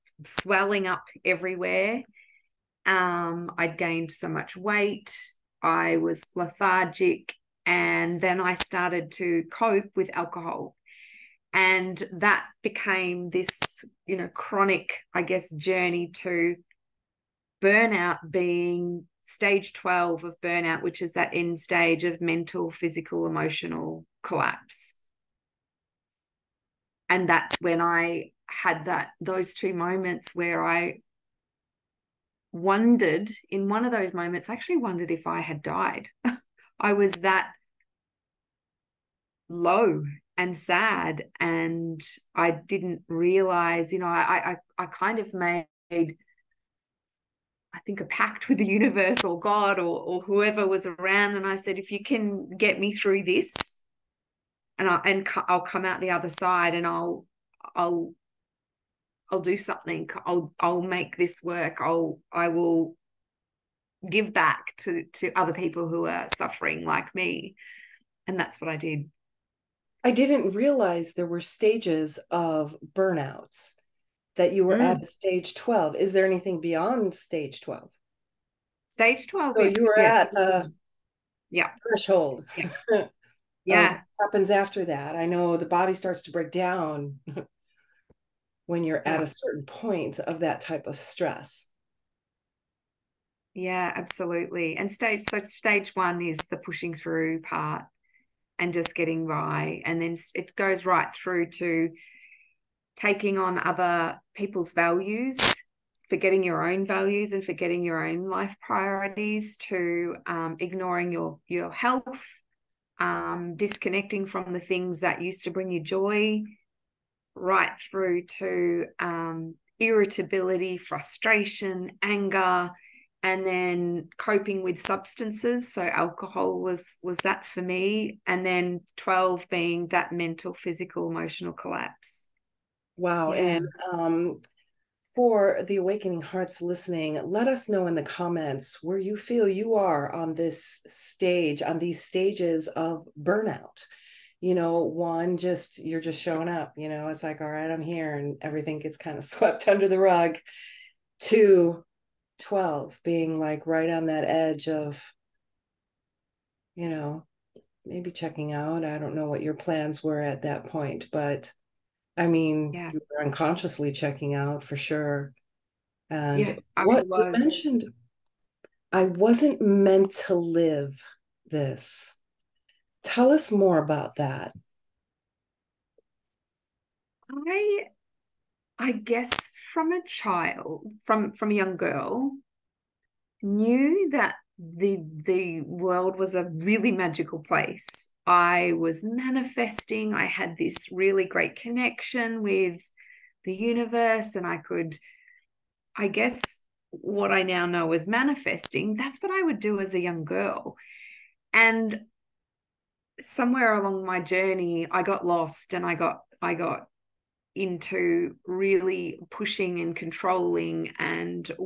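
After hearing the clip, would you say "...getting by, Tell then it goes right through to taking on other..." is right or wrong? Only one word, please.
wrong.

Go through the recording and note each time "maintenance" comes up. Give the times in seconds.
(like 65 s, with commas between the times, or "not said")
not said.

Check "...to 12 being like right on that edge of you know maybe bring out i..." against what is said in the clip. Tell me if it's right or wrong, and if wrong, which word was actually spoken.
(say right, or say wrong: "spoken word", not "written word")
wrong: "checking", not "bring".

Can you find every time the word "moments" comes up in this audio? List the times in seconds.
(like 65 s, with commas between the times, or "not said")
29 s, 34 s.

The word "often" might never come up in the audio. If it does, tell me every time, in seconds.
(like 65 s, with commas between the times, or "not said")
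not said.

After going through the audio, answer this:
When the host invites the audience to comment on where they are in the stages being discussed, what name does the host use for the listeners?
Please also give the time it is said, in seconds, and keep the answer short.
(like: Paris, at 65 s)
Awakening Hearts, at 135 s.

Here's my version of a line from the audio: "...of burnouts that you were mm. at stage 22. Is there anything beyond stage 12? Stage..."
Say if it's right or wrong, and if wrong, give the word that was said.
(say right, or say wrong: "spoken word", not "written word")
wrong: "12", not "22".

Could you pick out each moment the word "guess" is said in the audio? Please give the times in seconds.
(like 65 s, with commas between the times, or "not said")
15 s, 178 s, 196 s.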